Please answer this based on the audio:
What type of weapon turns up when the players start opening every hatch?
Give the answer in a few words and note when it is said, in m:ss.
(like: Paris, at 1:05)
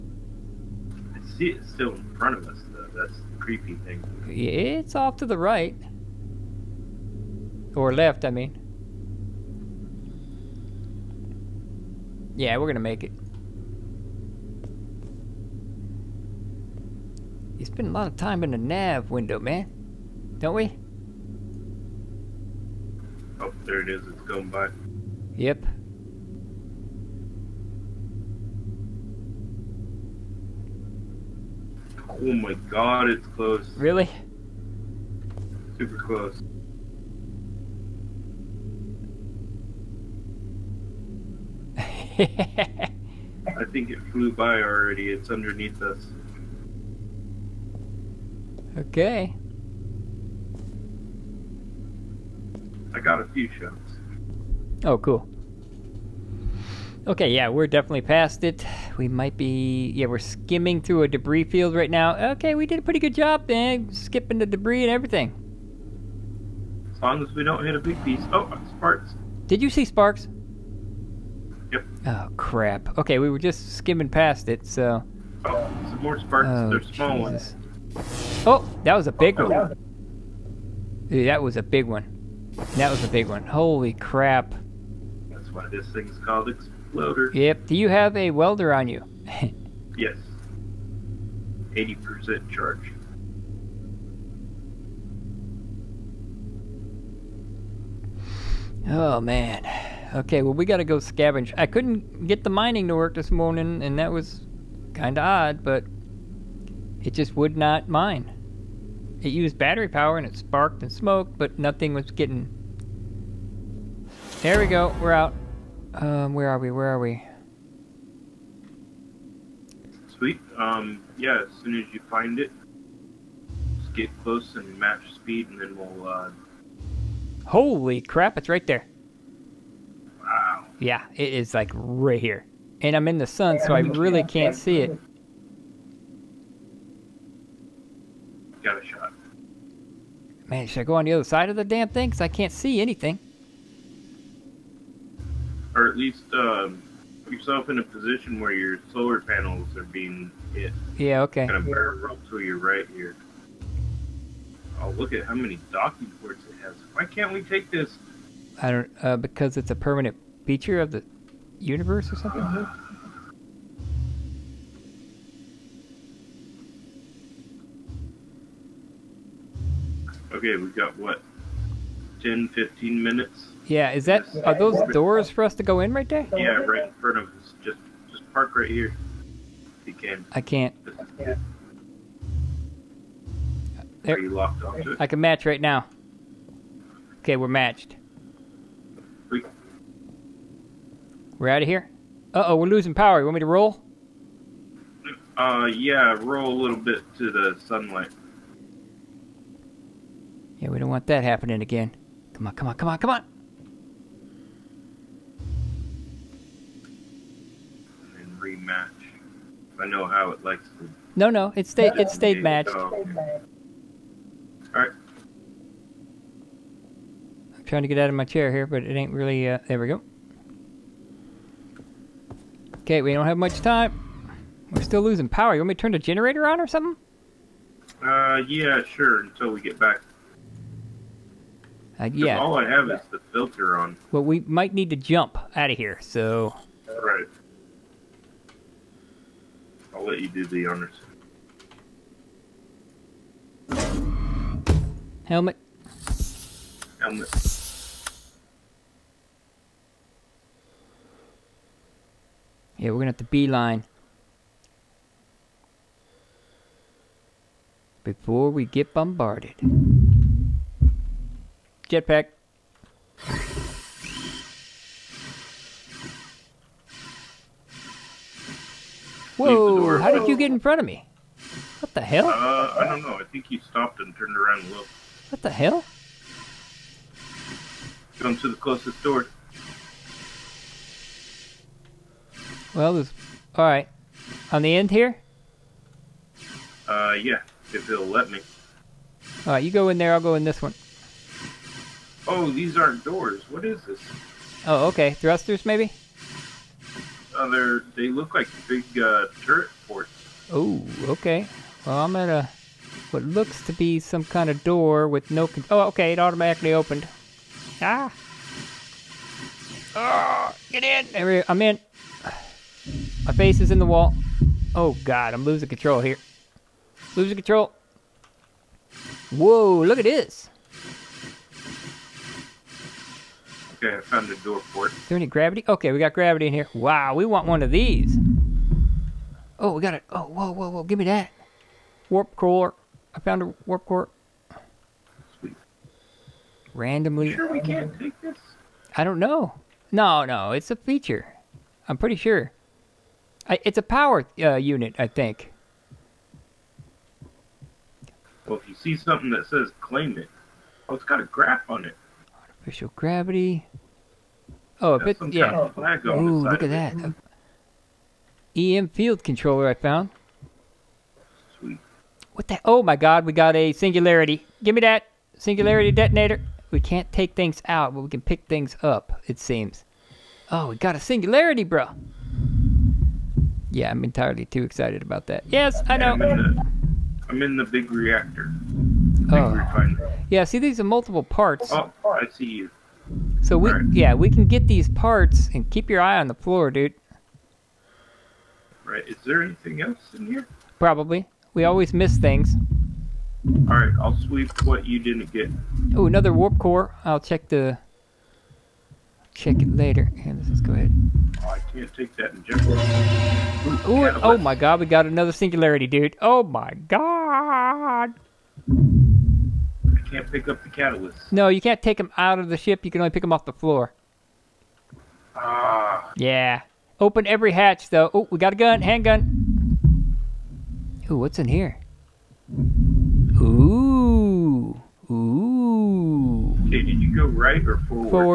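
handgun, at 6:58.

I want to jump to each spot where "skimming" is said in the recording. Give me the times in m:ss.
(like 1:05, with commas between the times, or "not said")
1:00, 1:13.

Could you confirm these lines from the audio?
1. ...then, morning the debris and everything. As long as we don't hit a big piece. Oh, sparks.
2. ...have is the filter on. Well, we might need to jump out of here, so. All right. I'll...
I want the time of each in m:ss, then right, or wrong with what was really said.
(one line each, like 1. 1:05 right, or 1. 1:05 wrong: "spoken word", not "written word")
1. 1:03 wrong: "skipping", not "morning"
2. 3:52 right.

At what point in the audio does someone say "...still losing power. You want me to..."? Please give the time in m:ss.
3:44.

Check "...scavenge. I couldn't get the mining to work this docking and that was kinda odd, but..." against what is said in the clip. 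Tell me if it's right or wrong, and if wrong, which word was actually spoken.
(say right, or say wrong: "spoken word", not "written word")
wrong: "morning", not "docking".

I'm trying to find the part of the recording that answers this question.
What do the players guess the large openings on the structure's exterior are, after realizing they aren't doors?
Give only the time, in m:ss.
4:59.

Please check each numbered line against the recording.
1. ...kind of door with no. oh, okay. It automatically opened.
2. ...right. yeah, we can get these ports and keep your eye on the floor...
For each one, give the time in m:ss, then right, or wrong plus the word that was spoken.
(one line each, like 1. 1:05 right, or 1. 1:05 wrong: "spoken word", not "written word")
1. 5:04 right
2. 6:23 wrong: "parts", not "ports".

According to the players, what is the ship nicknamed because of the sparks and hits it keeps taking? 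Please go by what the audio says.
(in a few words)
exploder.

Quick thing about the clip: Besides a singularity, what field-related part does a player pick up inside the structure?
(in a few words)
EM field controller.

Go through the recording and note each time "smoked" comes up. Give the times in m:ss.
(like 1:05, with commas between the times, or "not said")
1:50.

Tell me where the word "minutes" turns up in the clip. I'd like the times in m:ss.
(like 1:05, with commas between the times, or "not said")
2:53.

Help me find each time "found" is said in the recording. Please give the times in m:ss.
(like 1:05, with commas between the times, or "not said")
5:24, 5:33, 5:59.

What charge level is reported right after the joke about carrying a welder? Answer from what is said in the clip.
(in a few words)
80%.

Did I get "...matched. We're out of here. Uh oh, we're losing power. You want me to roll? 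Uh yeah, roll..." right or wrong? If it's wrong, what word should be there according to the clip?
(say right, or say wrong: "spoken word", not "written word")
right.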